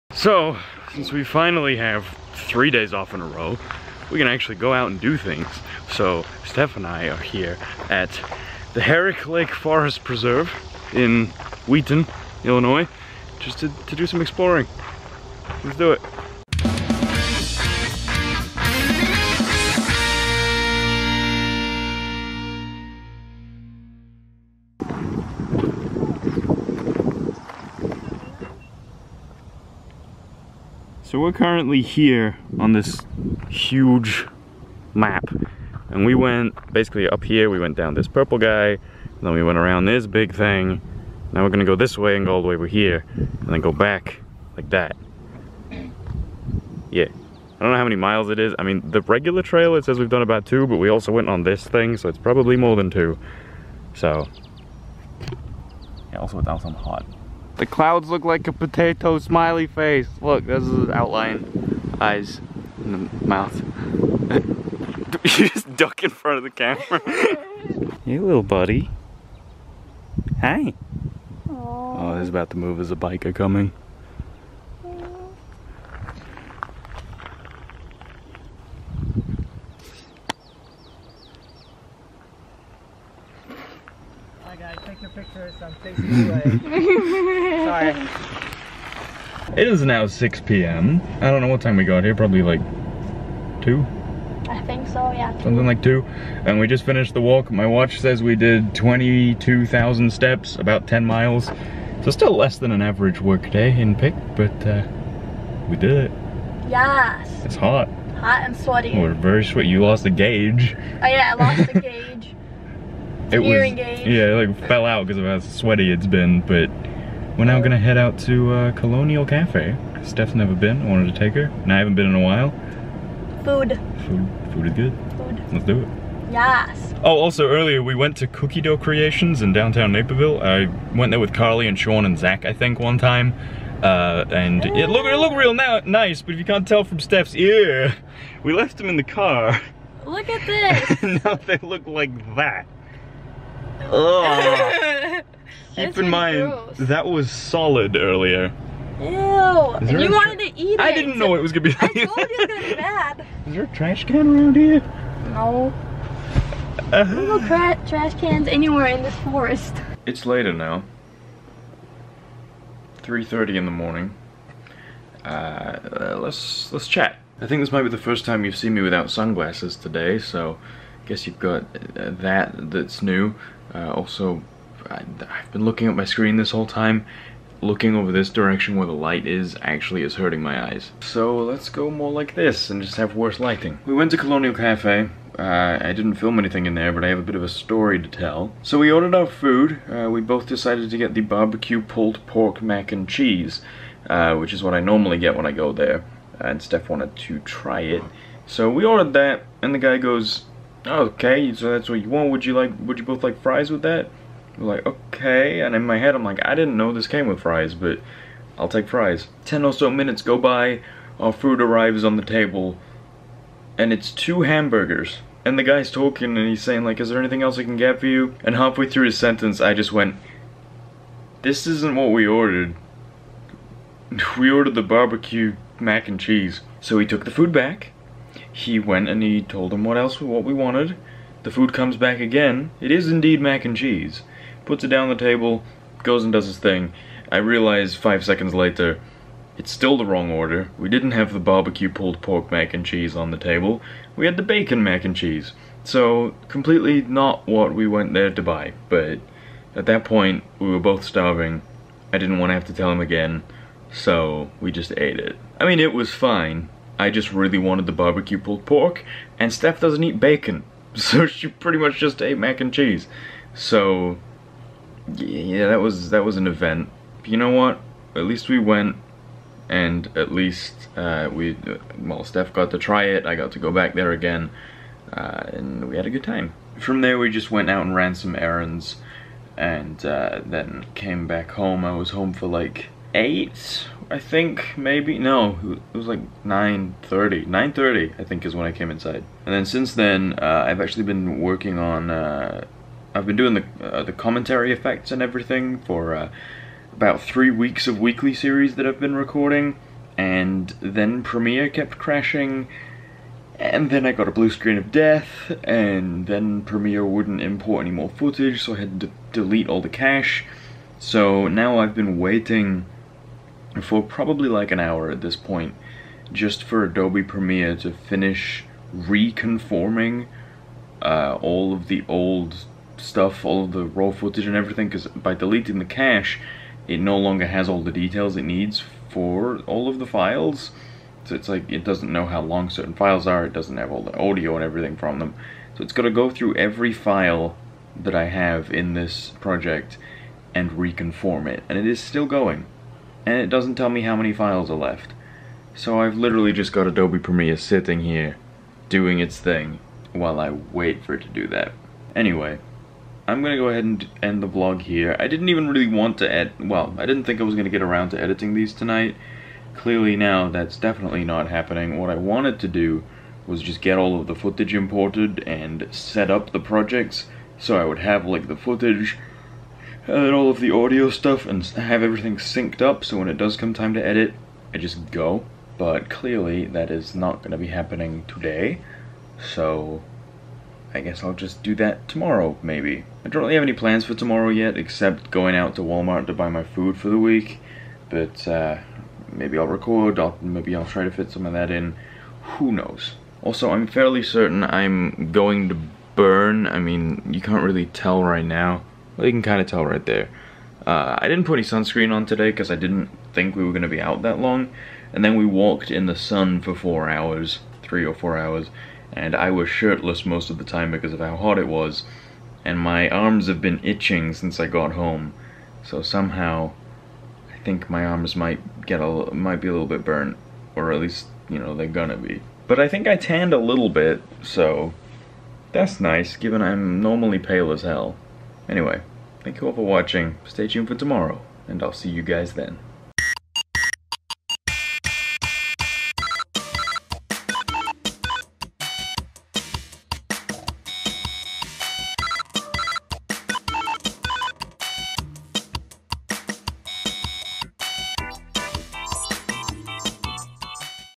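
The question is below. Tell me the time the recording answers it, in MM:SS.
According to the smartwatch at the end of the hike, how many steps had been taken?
01:38.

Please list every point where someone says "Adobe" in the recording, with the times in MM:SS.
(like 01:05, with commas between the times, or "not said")
05:16, 05:46.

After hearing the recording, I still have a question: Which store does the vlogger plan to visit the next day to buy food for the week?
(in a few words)
Walmart.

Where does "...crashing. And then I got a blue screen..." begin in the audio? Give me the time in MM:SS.
05:01.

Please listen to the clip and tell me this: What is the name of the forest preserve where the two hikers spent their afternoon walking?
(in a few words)
Herrick Lake Forest Preserve.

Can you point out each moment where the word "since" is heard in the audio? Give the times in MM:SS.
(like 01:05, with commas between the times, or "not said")
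00:00, 04:49, 06:54.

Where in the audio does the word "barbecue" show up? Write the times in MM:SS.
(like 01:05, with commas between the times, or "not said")
03:11, 03:44, 04:01, 04:17.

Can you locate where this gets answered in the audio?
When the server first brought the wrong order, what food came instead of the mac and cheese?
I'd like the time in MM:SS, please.
03:34.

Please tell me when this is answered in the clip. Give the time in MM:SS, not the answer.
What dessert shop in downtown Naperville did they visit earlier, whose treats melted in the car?
02:08.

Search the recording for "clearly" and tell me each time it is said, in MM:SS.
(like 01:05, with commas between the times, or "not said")
05:59, 06:16.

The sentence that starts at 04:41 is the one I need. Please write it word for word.
I was home for like eight, I think, maybe.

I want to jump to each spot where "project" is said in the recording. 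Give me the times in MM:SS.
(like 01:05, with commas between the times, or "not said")
05:39, 06:06.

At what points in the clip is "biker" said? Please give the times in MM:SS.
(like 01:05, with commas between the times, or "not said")
01:12.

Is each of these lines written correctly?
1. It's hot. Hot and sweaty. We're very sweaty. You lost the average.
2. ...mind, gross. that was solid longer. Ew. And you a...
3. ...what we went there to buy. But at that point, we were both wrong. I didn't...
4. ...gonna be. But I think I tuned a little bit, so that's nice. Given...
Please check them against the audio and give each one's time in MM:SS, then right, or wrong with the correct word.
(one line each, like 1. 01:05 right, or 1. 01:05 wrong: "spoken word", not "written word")
1. 01:47 wrong: "gauge", not "average"
2. 02:26 wrong: "earlier", not "longer"
3. 04:07 wrong: "starving", not "wrong"
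4. 07:01 wrong: "tanned", not "tuned".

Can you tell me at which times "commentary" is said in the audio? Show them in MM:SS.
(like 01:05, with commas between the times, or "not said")
04:54.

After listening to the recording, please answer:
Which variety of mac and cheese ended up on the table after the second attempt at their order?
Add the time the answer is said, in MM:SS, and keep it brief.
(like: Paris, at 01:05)
bacon mac and cheese, at 04:04.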